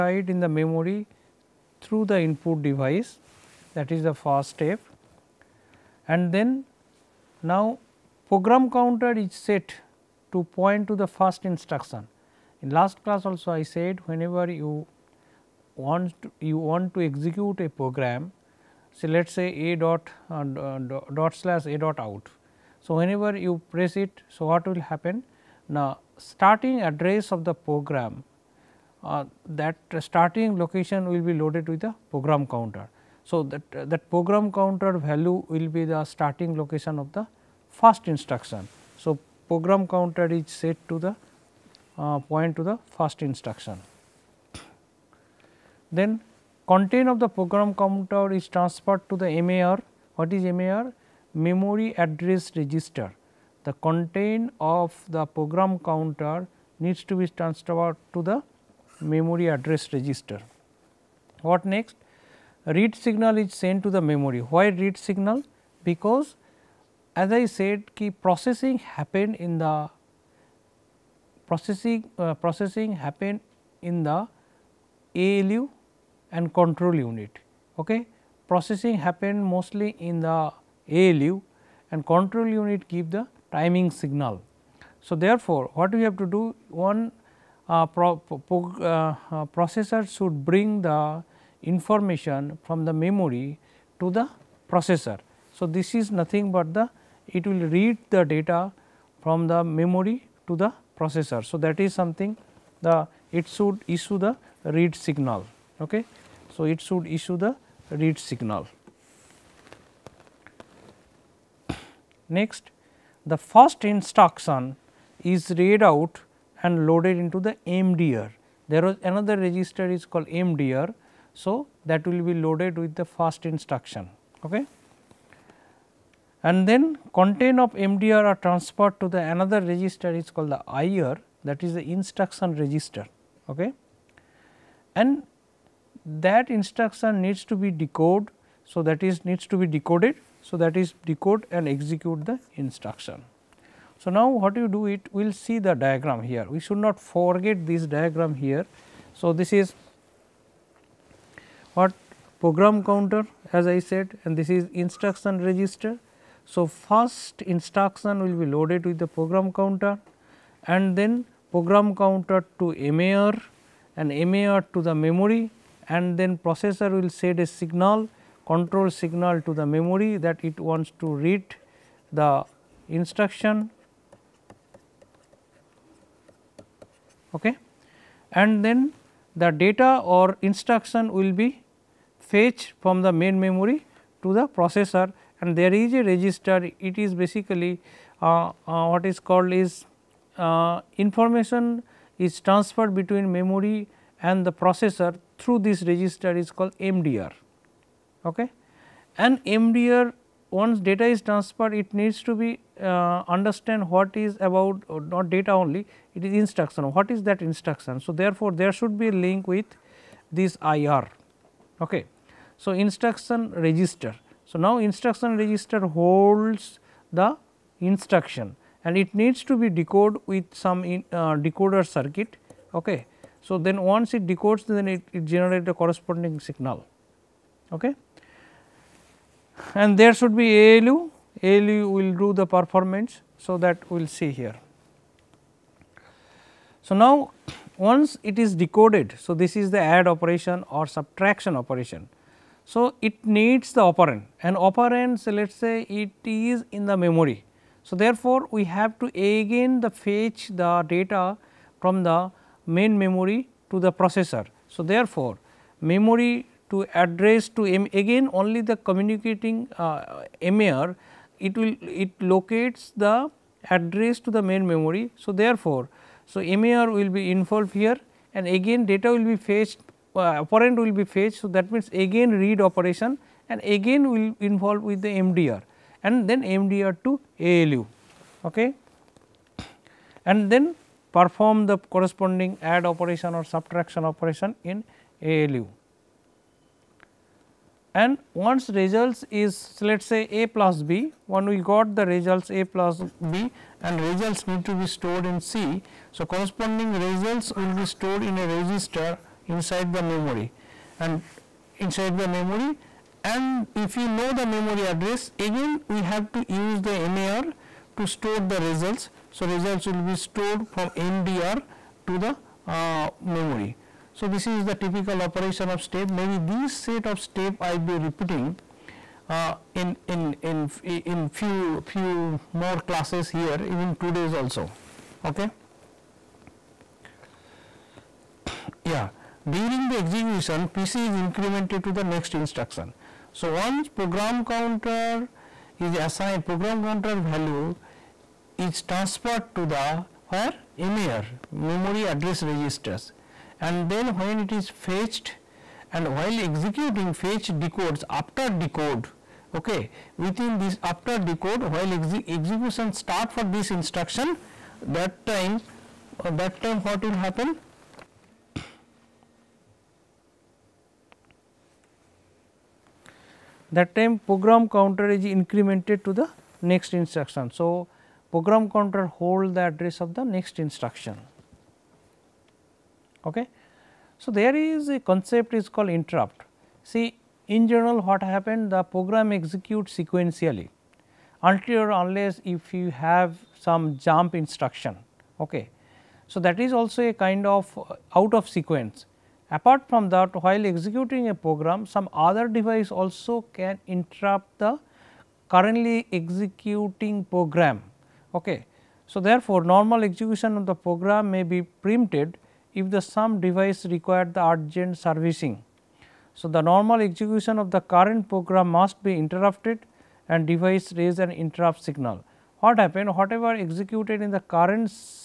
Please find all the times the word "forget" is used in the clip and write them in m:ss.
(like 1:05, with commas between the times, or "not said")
2:26.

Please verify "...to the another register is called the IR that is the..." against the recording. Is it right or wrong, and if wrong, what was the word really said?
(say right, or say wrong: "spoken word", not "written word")
right.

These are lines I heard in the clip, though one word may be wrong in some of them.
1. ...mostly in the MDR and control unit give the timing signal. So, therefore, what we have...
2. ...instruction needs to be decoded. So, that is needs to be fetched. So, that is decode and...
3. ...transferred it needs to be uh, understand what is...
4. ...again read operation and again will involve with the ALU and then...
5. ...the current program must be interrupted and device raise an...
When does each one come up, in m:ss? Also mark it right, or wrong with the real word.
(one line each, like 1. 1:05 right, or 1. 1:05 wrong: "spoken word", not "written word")
1. 1:19 wrong: "ALU", not "MDR"
2. 2:16 wrong: "decoded", not "fetched"
3. 3:21 right
4. 4:31 wrong: "MDR", not "ALU"
5. 6:47 right.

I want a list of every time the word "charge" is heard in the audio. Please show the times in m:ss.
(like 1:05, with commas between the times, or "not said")
not said.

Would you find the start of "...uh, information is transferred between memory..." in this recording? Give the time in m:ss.
3:10.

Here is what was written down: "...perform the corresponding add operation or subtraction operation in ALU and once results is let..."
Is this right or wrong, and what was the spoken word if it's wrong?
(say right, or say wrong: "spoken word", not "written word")
right.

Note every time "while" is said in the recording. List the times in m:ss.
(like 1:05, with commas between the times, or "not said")
5:46, 5:51, 6:30.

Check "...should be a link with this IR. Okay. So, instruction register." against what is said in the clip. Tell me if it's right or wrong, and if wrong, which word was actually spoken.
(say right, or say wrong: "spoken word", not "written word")
right.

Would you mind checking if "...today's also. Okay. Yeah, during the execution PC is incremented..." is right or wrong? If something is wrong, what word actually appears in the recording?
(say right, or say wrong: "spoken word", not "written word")
right.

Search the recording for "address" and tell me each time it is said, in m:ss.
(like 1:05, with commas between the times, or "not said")
0:26, 0:51, 0:59, 4:16, 4:23, 5:04, 5:42, 6:09.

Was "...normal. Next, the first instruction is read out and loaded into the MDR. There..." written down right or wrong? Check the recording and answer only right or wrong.
wrong.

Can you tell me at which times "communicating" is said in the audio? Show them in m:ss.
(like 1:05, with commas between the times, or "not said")
4:18.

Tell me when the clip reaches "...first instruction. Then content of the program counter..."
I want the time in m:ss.
0:42.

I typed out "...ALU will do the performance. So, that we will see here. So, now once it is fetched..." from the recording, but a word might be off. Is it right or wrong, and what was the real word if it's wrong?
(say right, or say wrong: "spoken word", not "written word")
wrong: "decoded", not "fetched".